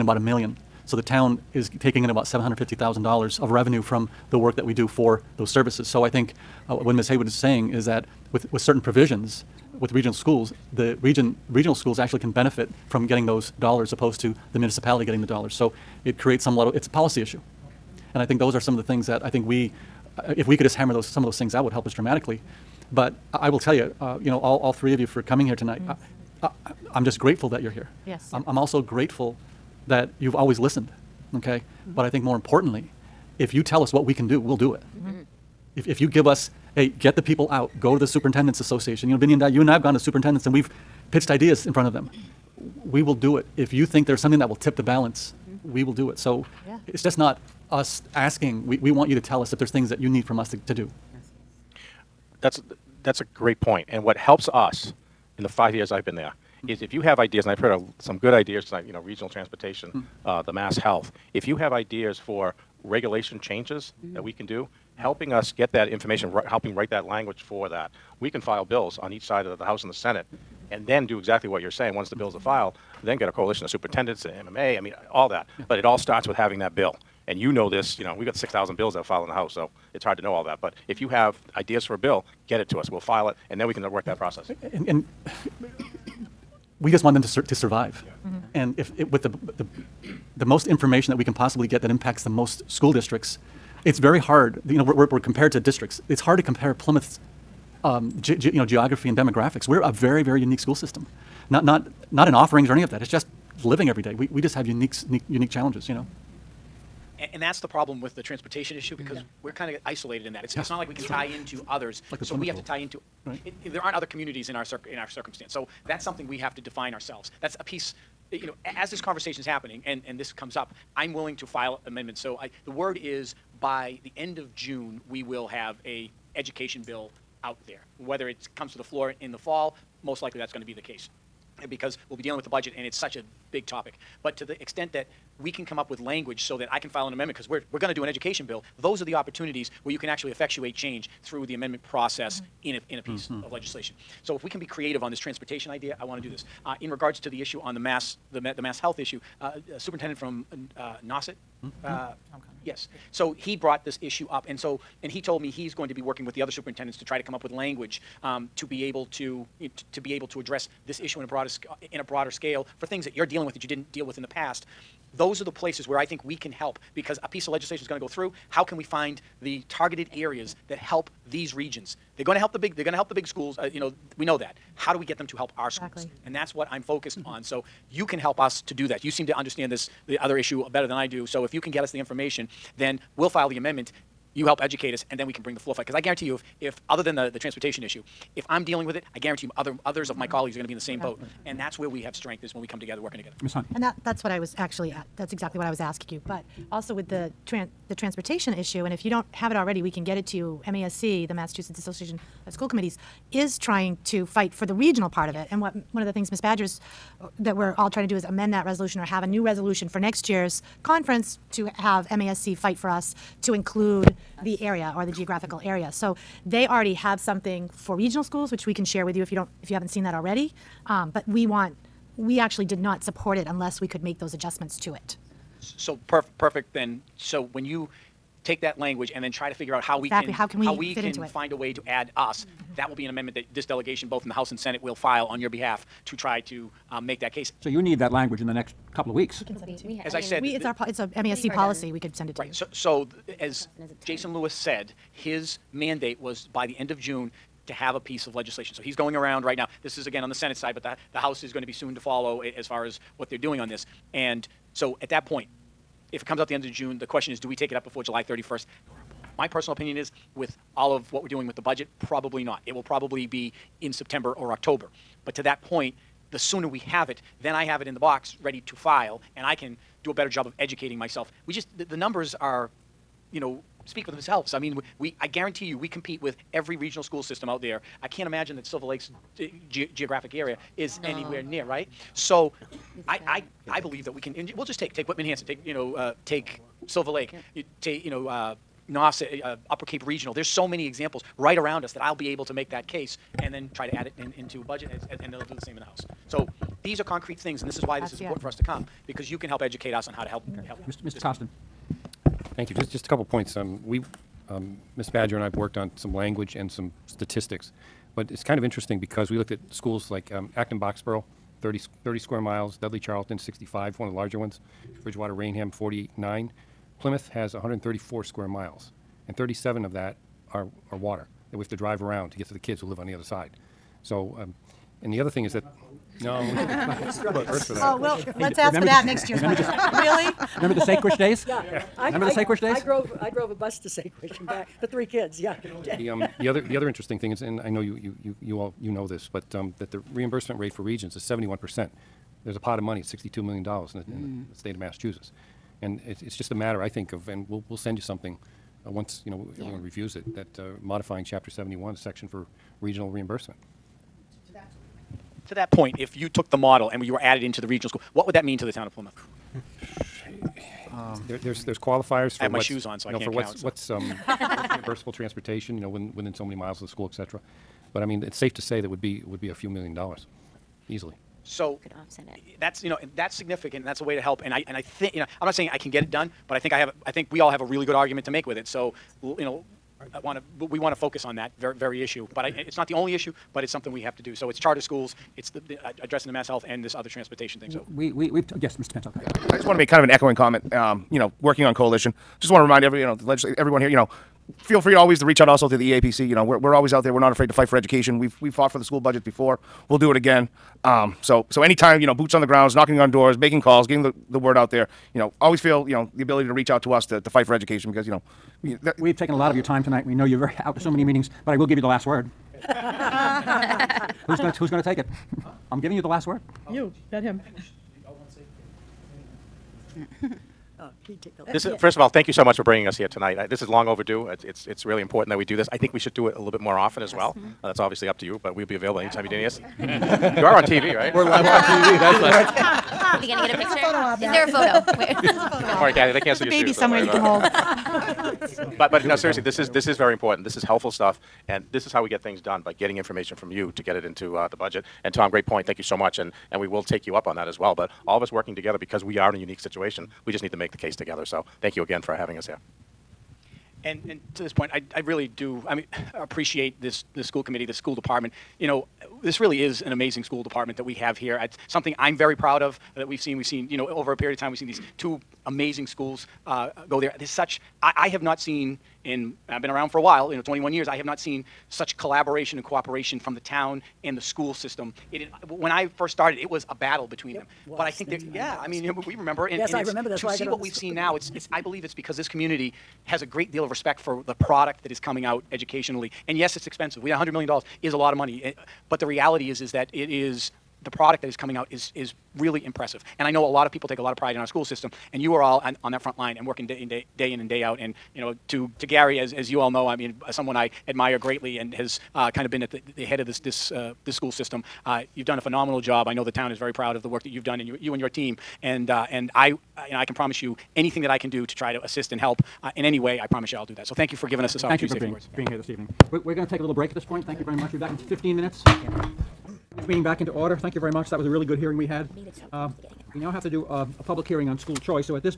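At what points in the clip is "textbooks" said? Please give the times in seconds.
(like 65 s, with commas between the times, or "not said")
not said.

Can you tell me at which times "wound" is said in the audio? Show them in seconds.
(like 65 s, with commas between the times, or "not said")
not said.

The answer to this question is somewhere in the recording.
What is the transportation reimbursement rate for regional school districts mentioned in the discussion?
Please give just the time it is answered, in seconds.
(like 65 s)
341 s.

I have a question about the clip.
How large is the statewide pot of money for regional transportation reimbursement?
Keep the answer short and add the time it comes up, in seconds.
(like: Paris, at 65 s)
$62 million, at 343 s.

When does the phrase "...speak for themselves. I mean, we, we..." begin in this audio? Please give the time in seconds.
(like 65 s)
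273 s.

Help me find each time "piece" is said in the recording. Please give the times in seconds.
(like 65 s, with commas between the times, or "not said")
117 s, 143 s, 167 s, 247 s.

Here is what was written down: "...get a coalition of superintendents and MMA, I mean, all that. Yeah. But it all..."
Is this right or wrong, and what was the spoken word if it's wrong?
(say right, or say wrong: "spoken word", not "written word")
right.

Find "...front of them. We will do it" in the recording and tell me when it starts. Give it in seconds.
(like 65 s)
41 s.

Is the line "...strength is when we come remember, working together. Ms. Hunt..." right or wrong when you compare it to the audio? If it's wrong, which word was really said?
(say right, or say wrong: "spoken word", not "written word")
wrong: "together", not "remember".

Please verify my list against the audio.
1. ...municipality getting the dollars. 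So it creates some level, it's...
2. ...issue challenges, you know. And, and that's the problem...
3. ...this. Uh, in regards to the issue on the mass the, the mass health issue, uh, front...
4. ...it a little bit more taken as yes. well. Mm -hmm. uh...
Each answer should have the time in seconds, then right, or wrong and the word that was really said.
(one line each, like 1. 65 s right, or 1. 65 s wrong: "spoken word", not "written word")
1. 14 s right
2. 105 s wrong: "unique", not "issue"
3. 146 s wrong: "superintendent", not "front"
4. 426 s wrong: "often", not "taken".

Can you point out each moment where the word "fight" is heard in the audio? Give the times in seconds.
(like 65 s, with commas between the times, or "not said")
185 s, 204 s, 212 s, 397 s, 407 s.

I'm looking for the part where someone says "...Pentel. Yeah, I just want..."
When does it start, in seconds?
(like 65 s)
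388 s.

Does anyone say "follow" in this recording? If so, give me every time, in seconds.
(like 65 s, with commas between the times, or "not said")
251 s.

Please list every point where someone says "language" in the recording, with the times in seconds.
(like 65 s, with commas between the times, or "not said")
67 s, 135 s, 157 s, 228 s, 238 s, 306 s.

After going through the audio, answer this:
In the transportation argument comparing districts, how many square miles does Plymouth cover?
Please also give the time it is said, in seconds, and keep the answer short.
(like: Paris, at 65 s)
134, at 317 s.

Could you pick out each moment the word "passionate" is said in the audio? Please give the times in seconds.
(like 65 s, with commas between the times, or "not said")
not said.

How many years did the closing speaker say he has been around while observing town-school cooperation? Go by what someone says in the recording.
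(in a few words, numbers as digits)
21.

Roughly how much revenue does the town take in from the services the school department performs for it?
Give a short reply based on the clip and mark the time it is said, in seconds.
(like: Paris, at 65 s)
$750,000, at 2 s.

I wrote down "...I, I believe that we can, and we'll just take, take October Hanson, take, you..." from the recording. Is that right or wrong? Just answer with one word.
wrong.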